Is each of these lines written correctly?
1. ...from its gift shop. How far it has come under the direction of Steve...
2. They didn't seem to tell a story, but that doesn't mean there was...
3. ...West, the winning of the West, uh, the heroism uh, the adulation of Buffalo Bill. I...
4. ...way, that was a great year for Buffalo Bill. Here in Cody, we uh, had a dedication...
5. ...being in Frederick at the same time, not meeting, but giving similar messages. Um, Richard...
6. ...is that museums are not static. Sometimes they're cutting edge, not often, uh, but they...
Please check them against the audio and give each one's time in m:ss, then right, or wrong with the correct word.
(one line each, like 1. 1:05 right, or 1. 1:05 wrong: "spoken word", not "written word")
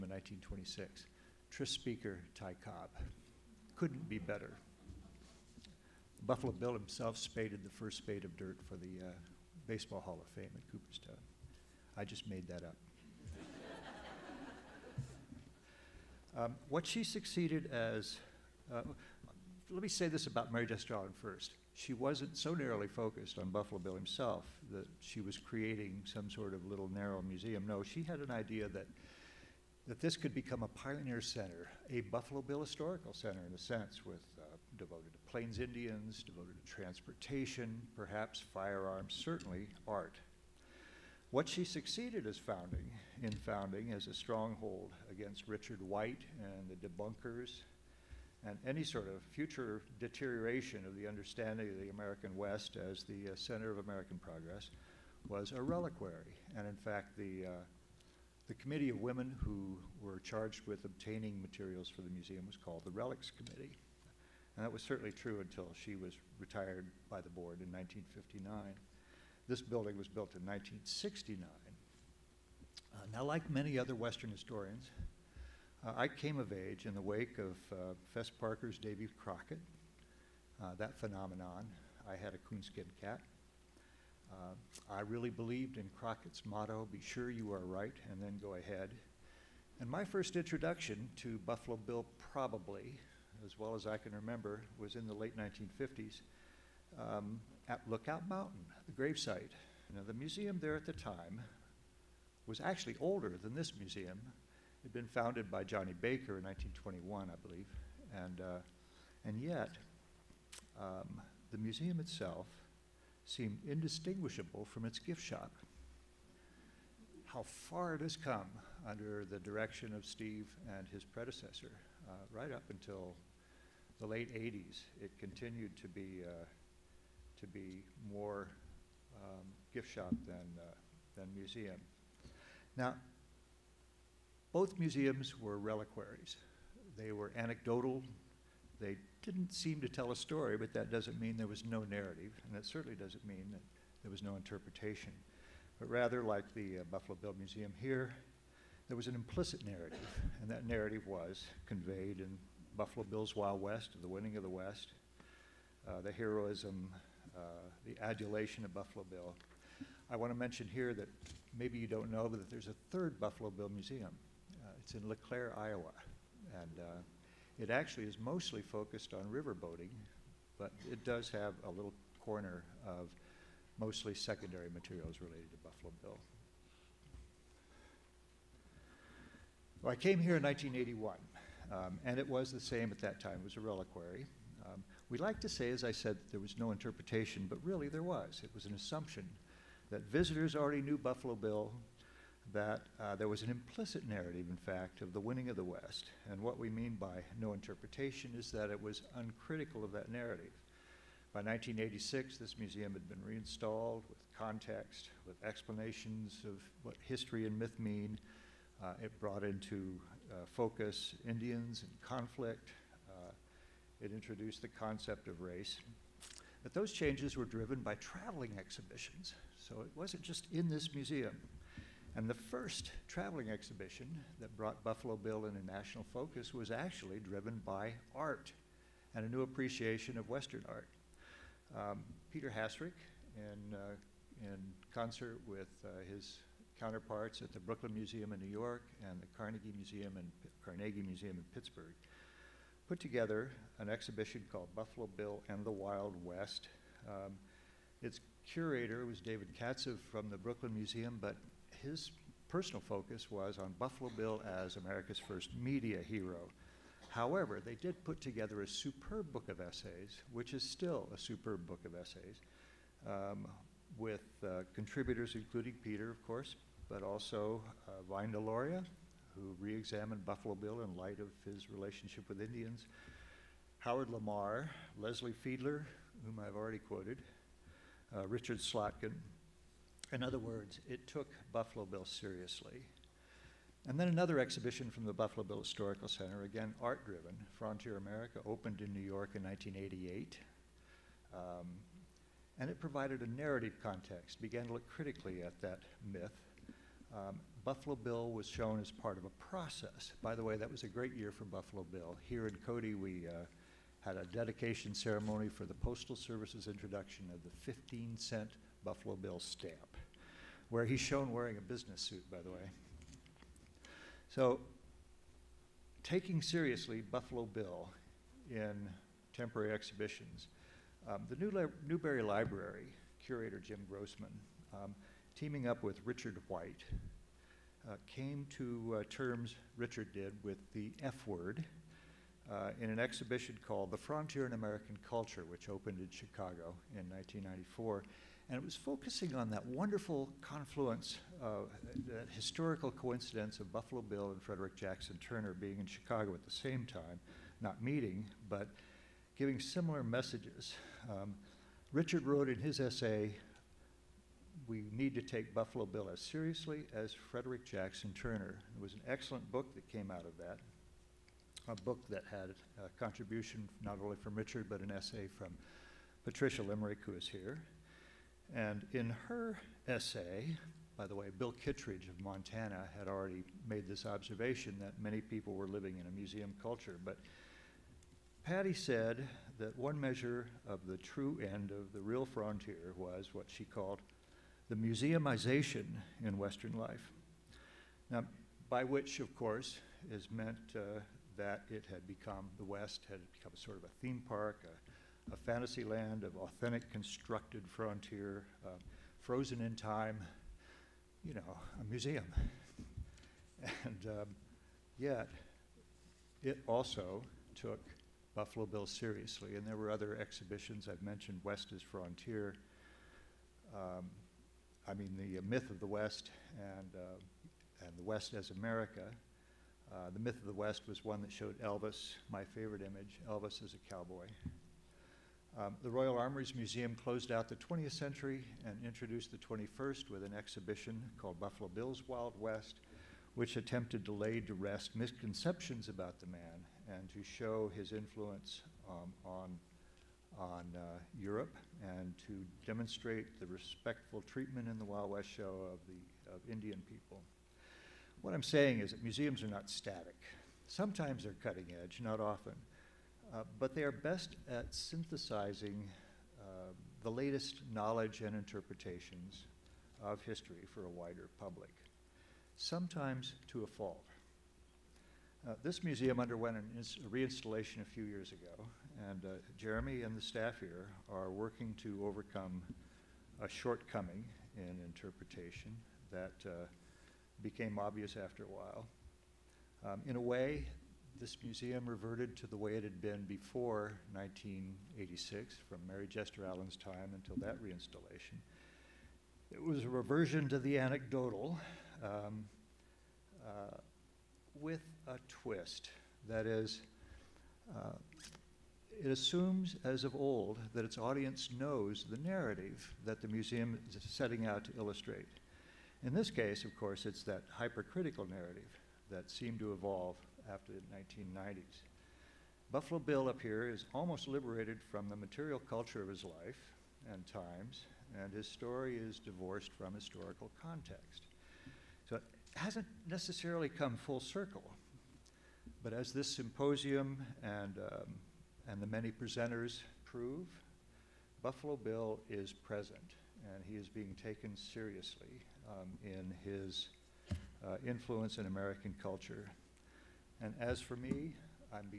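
1. 1:54 right
2. 2:18 right
3. 2:33 right
4. 5:00 right
5. 5:45 wrong: "Chicago", not "Frederick"
6. 7:28 right.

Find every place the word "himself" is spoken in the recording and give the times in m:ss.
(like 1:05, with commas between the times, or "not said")
0:06, 0:23.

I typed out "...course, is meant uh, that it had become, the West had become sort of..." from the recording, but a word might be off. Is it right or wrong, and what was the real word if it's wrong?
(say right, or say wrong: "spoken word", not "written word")
right.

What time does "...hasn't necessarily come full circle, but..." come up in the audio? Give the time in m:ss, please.
8:42.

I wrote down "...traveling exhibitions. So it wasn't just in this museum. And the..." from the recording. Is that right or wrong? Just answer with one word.
right.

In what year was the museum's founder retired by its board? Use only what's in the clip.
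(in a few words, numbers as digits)
1959.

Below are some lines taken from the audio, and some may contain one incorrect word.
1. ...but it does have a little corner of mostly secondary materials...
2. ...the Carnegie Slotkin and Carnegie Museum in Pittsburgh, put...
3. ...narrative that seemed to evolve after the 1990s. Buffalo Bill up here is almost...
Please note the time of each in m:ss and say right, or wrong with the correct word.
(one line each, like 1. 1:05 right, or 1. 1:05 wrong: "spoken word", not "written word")
1. 2:50 right
2. 3:59 wrong: "Museum", not "Slotkin"
3. 8:28 right.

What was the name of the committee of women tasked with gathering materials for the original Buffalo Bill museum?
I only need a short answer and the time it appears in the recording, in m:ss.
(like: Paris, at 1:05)
Relics Committee, at 1:02.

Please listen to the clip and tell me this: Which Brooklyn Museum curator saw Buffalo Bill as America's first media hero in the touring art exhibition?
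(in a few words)
David Katzive.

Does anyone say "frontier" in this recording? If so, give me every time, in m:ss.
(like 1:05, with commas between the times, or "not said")
4:47, 5:33, 6:22, 6:37, 6:51.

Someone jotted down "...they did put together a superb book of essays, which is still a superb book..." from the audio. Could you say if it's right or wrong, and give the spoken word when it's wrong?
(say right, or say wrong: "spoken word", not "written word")
right.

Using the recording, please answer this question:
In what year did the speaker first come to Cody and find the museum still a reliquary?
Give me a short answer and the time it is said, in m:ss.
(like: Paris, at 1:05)
1981, at 3:00.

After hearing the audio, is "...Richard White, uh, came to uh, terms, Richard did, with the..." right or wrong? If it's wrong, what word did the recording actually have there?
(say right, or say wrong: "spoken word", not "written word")
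right.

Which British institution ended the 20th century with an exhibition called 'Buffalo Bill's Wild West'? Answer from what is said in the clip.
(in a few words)
Royal Armories Museum.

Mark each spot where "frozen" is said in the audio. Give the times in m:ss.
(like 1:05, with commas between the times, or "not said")
6:39.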